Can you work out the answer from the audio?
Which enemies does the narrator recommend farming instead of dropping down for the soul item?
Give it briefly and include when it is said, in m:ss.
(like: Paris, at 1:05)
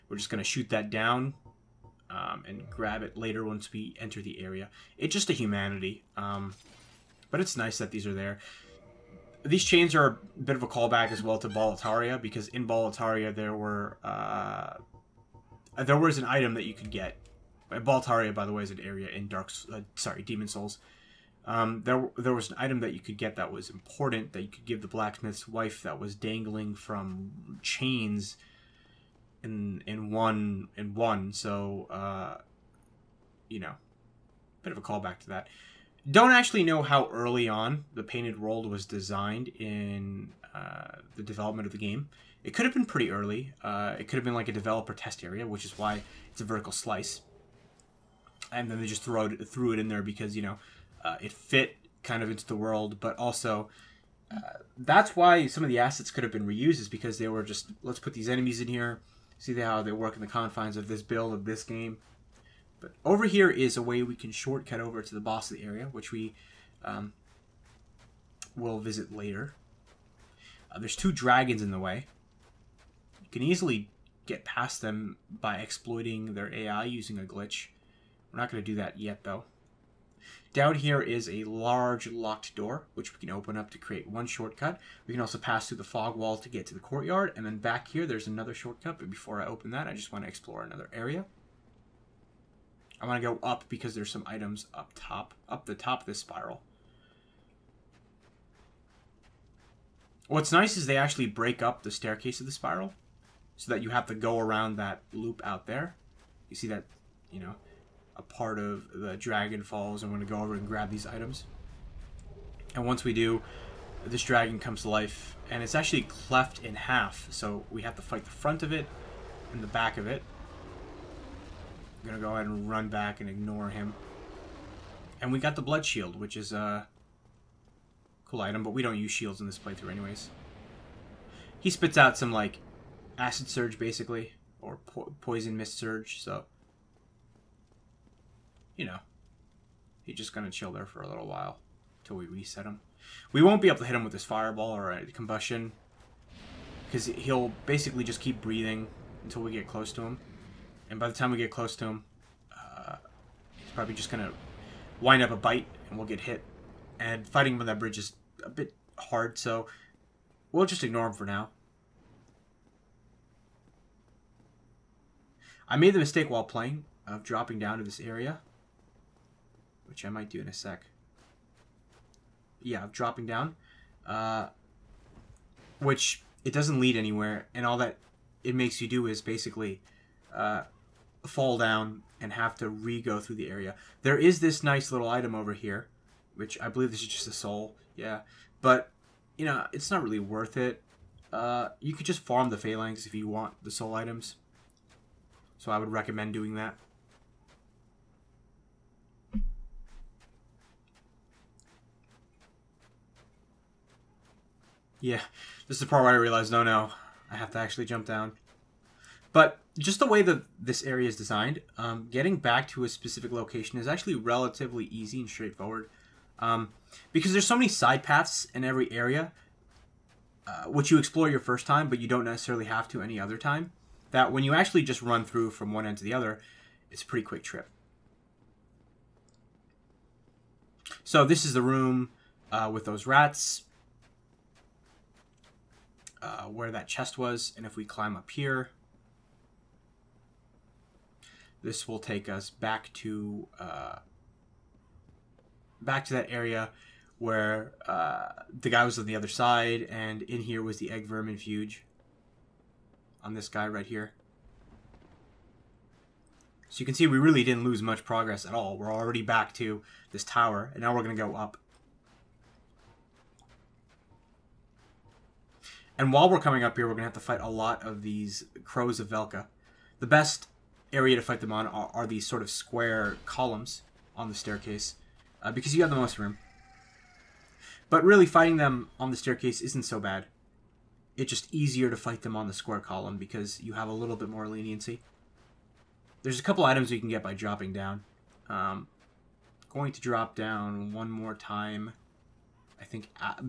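Phalanx, at 3:12.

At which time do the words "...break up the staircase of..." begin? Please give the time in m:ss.
1:41.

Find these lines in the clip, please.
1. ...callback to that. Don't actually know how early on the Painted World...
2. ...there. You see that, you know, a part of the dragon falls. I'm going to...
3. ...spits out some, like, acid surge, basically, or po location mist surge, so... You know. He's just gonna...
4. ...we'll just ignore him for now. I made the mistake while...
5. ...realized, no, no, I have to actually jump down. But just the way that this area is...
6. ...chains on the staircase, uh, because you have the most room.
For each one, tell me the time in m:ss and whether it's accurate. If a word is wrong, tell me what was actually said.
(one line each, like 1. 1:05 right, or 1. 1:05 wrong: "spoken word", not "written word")
1. 0:34 right
2. 1:45 right
3. 2:11 wrong: "poison", not "location"
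4. 2:40 right
5. 3:26 right
6. 4:33 wrong: "columns", not "chains".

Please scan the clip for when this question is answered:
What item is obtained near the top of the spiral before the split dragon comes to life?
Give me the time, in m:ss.
2:05.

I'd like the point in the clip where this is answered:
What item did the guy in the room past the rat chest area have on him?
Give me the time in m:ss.
4:10.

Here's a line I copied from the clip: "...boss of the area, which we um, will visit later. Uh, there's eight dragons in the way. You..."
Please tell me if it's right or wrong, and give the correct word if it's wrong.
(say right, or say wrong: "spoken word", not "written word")
wrong: "two", not "eight".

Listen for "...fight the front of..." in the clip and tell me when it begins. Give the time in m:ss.
1:58.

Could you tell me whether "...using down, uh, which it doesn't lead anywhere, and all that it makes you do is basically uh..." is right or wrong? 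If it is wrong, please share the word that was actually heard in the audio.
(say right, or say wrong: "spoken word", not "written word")
wrong: "dropping", not "using".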